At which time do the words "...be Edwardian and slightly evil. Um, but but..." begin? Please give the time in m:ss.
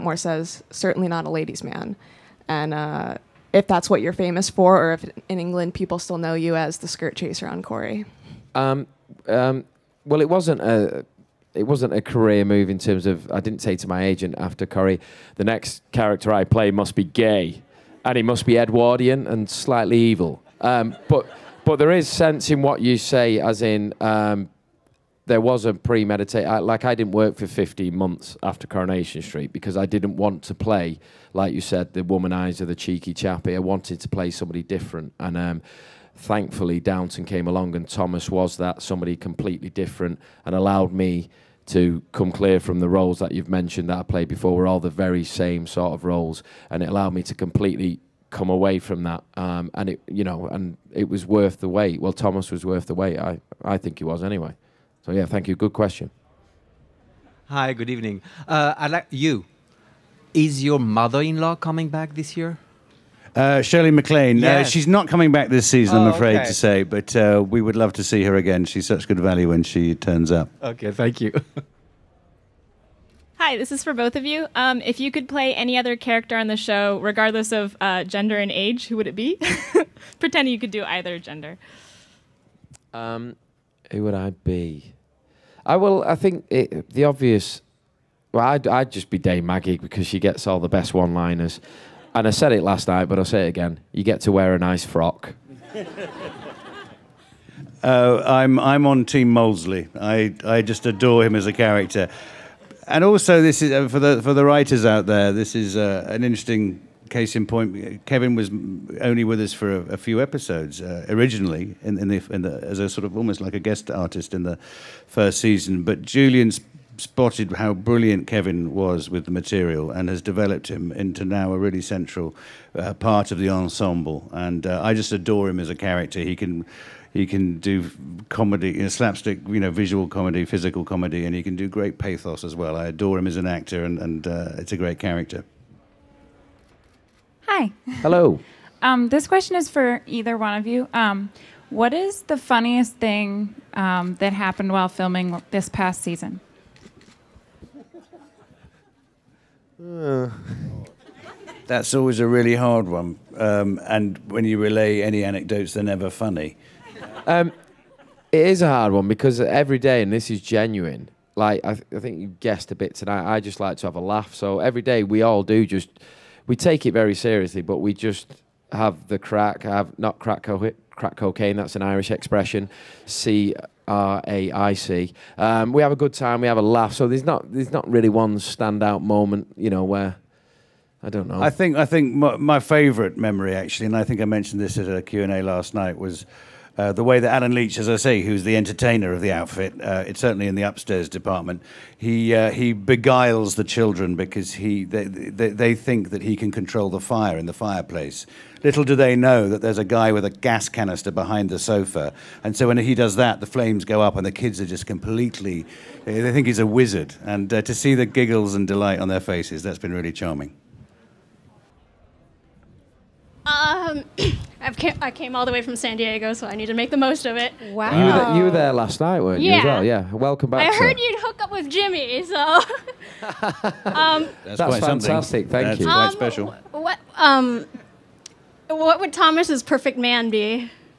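0:18.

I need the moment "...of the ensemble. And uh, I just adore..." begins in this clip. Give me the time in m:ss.
2:03.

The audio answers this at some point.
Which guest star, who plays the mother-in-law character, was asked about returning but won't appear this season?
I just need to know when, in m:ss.
1:03.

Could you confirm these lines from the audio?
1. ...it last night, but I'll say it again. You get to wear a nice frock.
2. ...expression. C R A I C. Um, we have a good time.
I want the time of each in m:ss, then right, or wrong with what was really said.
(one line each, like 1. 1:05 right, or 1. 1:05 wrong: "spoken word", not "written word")
1. 1:32 right
2. 2:52 right.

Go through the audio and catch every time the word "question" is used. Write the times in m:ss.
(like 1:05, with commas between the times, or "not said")
0:55, 2:19.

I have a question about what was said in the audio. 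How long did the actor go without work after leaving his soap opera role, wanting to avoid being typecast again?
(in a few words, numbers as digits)
15 months.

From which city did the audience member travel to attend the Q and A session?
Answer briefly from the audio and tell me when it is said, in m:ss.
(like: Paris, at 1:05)
San Diego, at 3:35.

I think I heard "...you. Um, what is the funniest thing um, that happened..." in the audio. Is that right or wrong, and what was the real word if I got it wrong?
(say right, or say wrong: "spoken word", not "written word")
right.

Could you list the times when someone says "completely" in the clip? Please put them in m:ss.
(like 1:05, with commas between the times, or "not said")
0:39, 0:47, 3:24.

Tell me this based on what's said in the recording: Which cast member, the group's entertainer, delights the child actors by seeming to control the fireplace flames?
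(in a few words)
Allen Leech.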